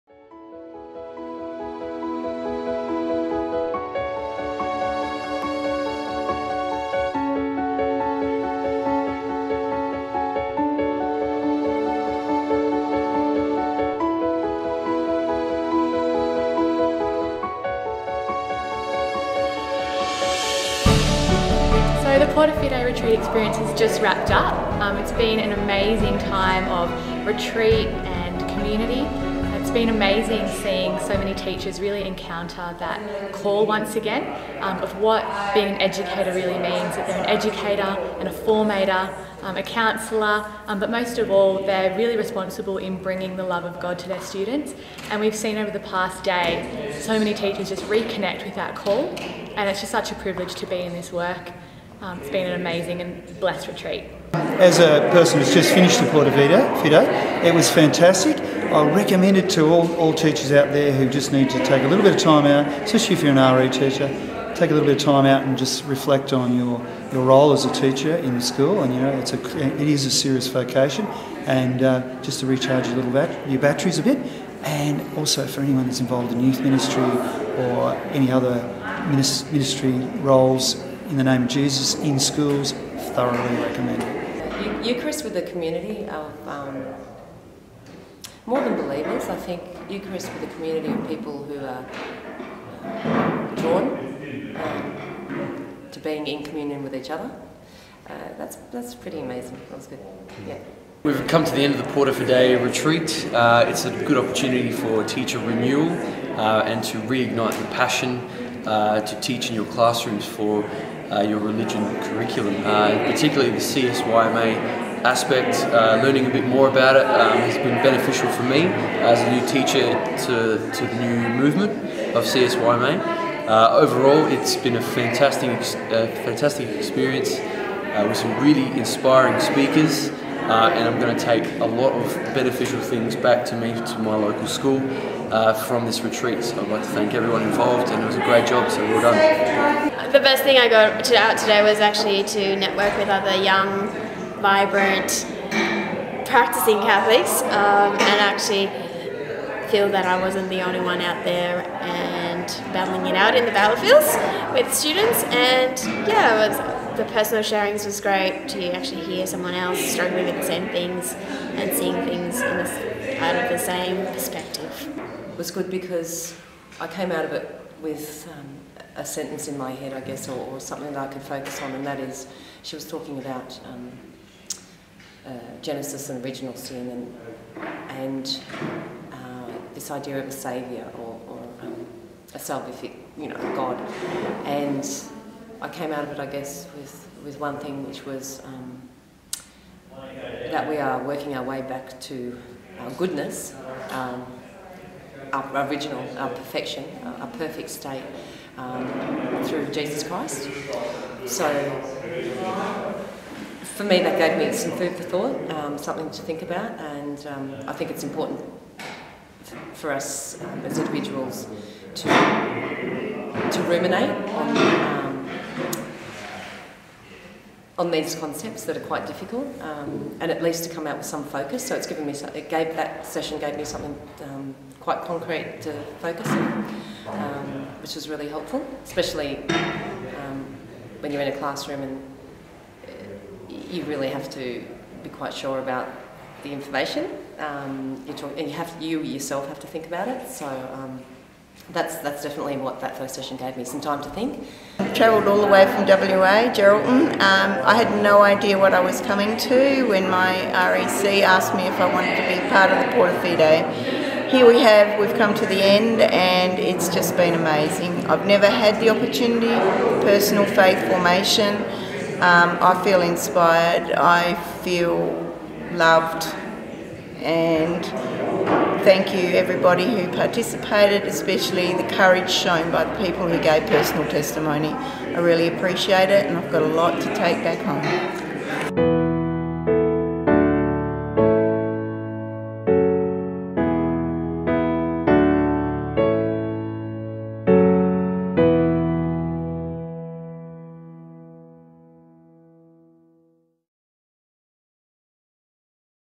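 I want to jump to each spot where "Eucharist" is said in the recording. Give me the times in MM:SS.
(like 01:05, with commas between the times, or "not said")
01:24, 01:29.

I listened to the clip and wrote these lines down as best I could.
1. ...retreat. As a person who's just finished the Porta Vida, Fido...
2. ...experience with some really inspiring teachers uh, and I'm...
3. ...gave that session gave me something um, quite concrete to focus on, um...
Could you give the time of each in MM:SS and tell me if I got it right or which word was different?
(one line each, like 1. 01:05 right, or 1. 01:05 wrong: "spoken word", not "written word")
1. 00:53 right
2. 02:06 wrong: "speakers", not "teachers"
3. 03:42 right.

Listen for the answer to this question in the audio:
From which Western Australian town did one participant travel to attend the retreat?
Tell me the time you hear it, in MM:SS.
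04:06.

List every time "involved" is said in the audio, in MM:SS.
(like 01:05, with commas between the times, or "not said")
01:15, 02:17.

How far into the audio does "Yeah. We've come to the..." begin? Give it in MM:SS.
01:40.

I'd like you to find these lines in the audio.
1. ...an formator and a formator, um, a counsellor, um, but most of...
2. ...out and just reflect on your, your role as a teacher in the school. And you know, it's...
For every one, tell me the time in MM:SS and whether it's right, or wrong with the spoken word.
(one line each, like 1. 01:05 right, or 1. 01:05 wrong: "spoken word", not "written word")
1. 00:37 wrong: "educator", not "formator"
2. 01:05 right.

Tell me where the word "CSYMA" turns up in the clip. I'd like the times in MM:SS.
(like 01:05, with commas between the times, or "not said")
01:53, 02:02.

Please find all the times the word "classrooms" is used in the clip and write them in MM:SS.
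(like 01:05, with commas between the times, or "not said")
01:49, 03:51.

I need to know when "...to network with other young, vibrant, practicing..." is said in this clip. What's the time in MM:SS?
02:22.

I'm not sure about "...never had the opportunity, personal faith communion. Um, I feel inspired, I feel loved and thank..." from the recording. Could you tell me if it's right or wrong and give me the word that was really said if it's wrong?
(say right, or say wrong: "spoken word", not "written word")
wrong: "formation", not "communion".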